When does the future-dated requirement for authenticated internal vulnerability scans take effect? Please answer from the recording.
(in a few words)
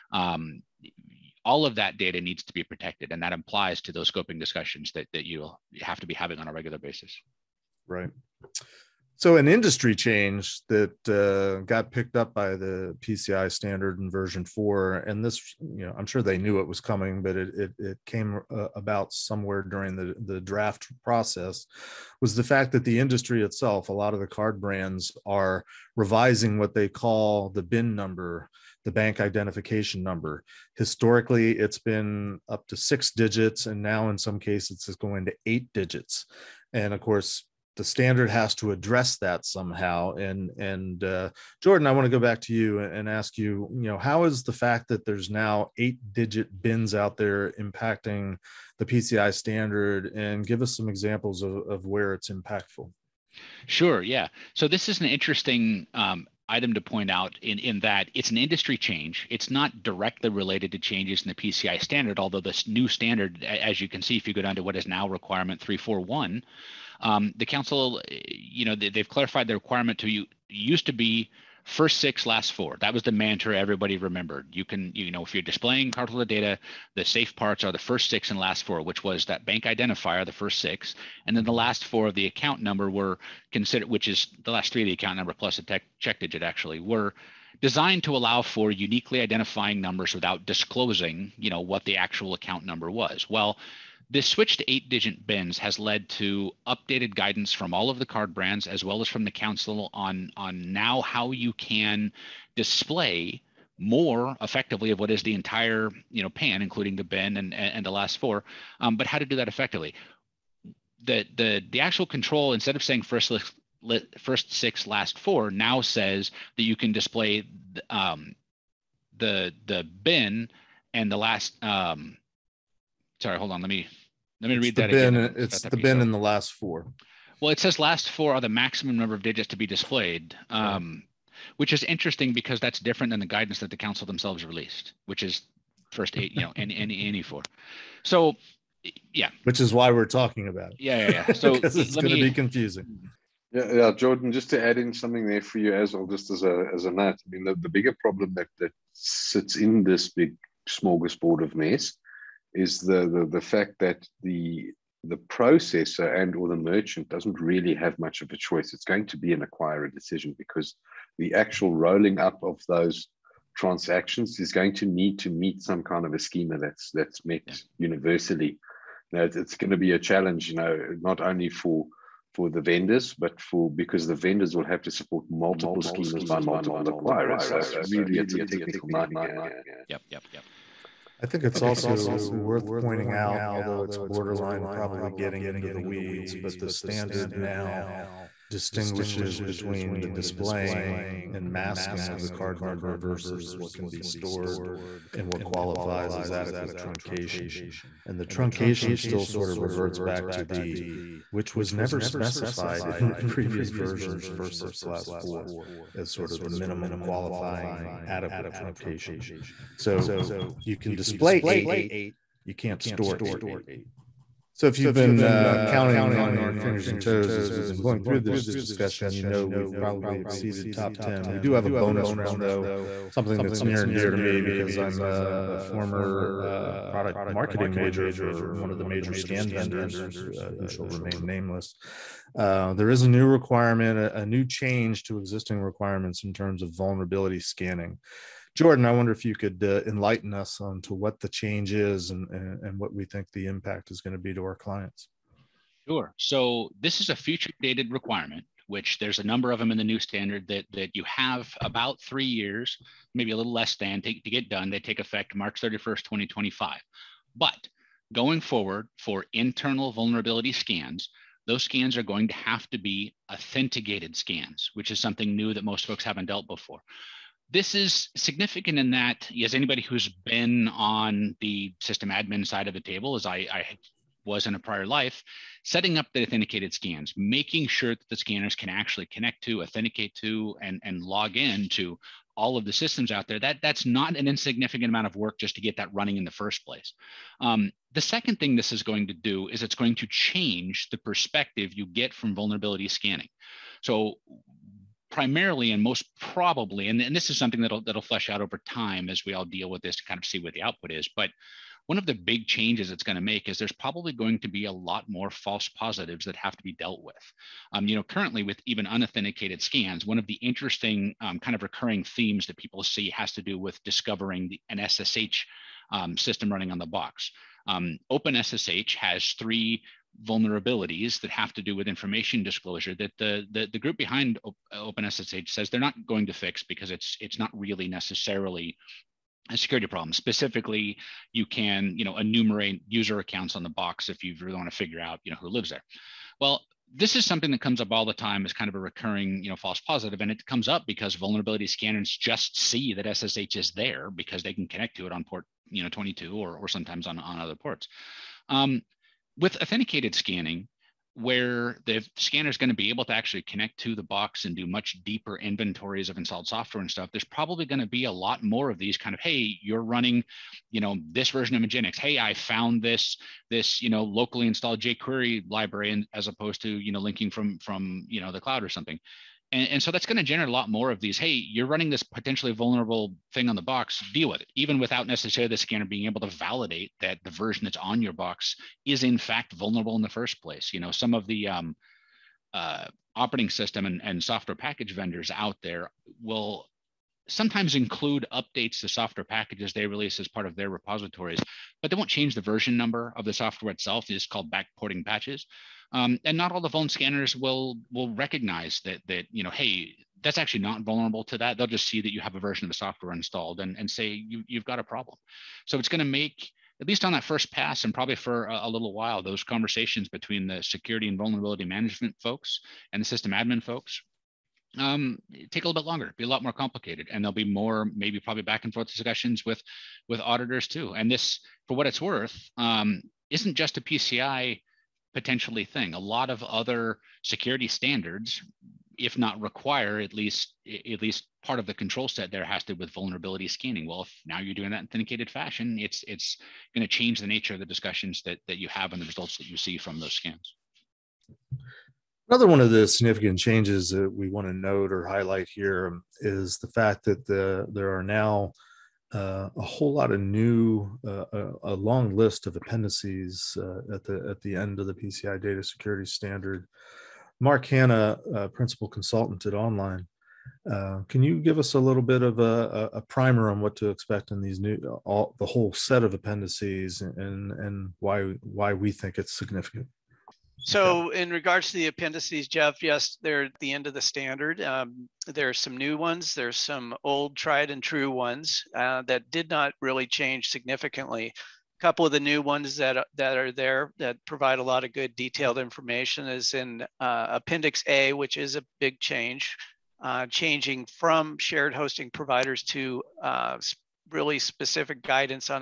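March 31st, 2025.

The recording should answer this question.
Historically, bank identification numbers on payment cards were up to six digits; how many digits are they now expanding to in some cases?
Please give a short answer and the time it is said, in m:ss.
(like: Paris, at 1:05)
8, at 0:35.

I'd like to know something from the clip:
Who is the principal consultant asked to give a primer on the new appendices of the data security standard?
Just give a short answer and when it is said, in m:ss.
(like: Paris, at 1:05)
Mark Hanna, at 7:37.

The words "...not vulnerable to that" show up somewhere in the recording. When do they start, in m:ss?
6:40.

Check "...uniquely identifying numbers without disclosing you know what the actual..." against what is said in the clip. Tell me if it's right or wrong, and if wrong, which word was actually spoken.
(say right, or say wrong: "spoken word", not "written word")
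right.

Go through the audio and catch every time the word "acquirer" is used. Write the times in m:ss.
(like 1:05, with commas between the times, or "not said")
2:39, 2:56.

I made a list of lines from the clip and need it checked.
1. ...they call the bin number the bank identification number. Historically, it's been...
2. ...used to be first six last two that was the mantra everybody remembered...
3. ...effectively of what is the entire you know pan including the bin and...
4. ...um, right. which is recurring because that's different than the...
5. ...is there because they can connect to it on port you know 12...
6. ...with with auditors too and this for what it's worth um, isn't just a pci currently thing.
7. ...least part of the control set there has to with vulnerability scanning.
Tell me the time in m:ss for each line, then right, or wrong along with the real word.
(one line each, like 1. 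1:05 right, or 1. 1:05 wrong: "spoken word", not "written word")
1. 0:26 right
2. 1:10 wrong: "four", not "two"
3. 1:44 right
4. 2:10 wrong: "interesting", not "recurring"
5. 5:43 wrong: "22", not "12"
6. 6:59 wrong: "potentially", not "currently"
7. 7:11 right.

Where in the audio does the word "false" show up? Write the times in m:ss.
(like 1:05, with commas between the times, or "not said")
5:05, 5:39.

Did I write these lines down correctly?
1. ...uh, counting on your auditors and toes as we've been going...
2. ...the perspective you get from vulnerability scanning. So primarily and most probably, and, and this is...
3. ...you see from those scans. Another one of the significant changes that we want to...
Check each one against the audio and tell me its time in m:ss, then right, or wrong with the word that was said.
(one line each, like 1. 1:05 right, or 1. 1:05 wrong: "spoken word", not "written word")
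1. 3:35 wrong: "fingers", not "auditors"
2. 4:50 right
3. 7:19 right.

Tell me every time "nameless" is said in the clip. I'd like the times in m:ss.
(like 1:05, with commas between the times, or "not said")
3:51.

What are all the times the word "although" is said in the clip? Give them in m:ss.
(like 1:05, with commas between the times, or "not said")
1:02, 3:03.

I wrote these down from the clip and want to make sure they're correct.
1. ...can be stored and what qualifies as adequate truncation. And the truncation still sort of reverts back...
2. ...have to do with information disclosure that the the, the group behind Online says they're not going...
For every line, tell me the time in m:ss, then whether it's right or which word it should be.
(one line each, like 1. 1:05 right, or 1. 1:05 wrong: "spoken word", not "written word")
1. 3:13 right
2. 5:21 wrong: "OpenSSH", not "Online".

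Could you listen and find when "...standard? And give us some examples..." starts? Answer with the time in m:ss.
0:49.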